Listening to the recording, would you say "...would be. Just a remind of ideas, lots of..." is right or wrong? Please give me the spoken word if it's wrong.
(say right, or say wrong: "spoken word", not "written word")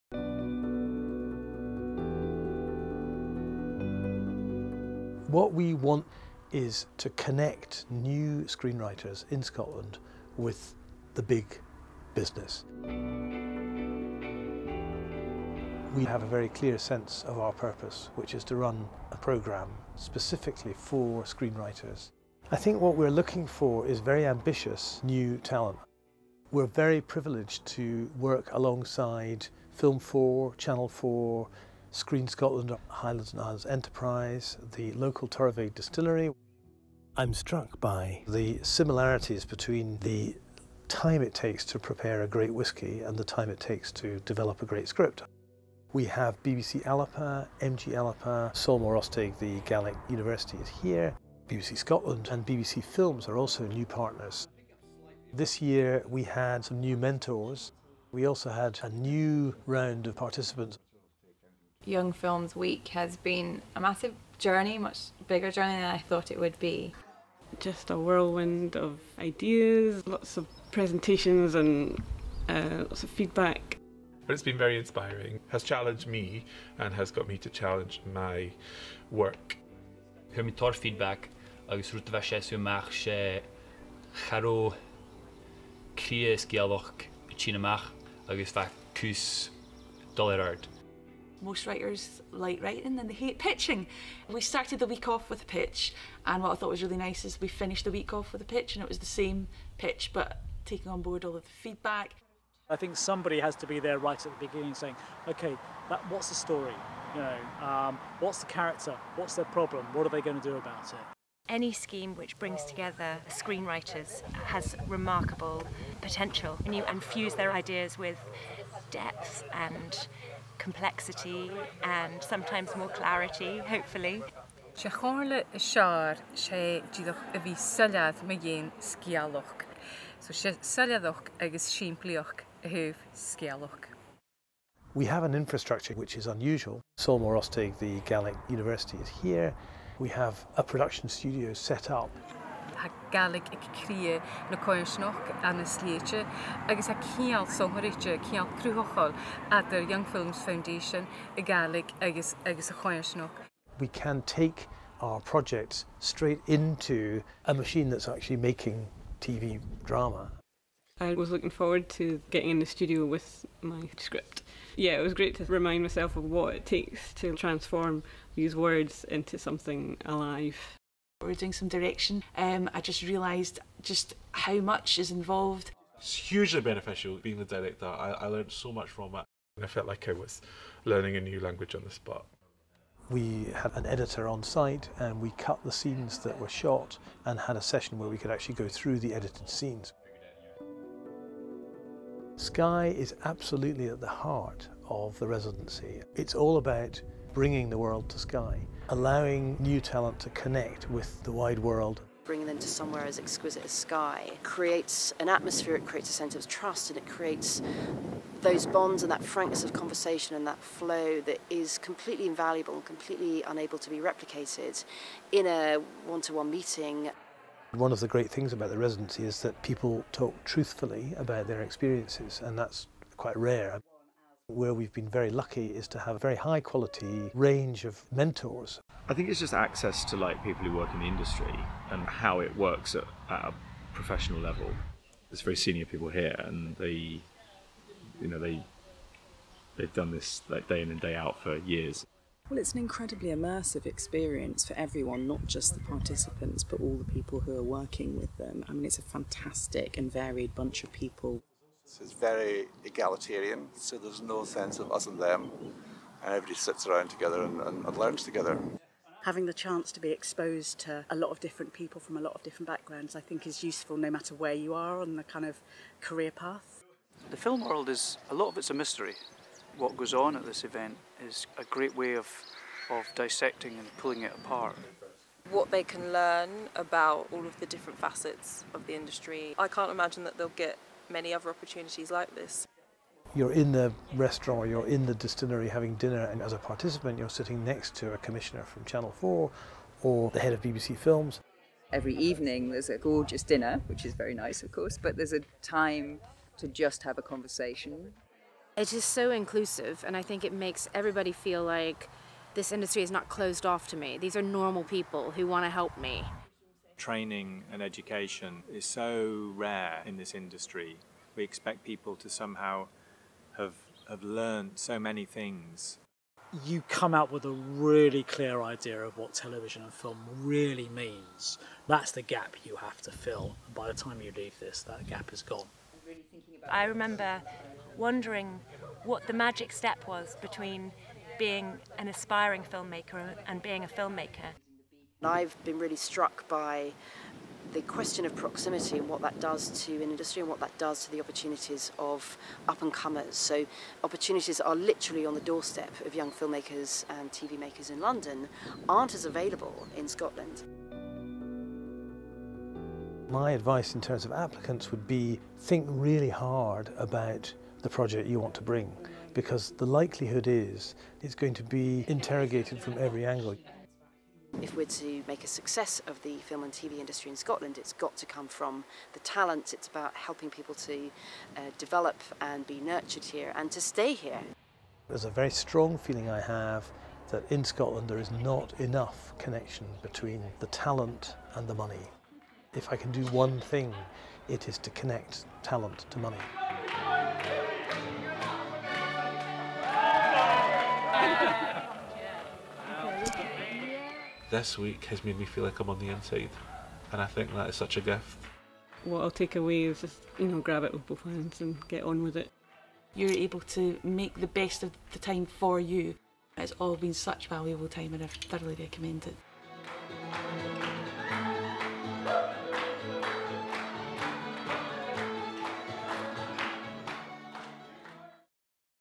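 wrong: "whirlwind", not "remind".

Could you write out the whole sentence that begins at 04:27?
The film world is a lot of it's a mystery.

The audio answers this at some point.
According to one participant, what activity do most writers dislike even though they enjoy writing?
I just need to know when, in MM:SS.
01:33.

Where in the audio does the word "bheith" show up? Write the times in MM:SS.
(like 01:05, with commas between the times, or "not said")
01:22, 01:28.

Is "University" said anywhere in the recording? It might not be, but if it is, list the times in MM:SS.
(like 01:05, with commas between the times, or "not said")
00:50, 02:18.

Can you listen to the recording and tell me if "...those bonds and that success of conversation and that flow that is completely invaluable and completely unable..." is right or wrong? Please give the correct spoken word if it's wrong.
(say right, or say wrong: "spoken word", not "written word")
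wrong: "frankness", not "success".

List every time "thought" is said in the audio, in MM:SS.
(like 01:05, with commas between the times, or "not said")
01:05, 01:36.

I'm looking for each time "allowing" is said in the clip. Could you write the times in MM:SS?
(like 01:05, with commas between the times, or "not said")
03:18.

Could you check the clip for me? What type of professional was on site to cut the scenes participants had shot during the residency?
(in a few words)
An editor.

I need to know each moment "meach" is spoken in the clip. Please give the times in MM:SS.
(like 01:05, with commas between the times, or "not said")
01:22, 01:27.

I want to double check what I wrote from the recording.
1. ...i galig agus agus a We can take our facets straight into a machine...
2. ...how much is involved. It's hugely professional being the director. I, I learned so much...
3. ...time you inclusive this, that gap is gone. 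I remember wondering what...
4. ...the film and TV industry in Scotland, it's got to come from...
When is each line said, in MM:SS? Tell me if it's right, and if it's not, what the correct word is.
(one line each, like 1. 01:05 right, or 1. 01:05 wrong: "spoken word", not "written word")
1. 02:31 wrong: "projects", not "facets"
2. 02:54 wrong: "beneficial", not "professional"
3. 05:23 wrong: "leave", not "inclusive"
4. 06:06 right.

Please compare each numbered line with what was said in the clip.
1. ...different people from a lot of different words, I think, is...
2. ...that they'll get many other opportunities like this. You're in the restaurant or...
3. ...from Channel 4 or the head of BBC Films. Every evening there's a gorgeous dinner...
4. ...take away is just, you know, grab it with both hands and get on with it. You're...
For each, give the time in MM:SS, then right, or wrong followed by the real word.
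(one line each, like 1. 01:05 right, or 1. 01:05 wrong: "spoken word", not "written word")
1. 04:21 wrong: "backgrounds", not "words"
2. 04:40 right
3. 04:48 right
4. 06:39 right.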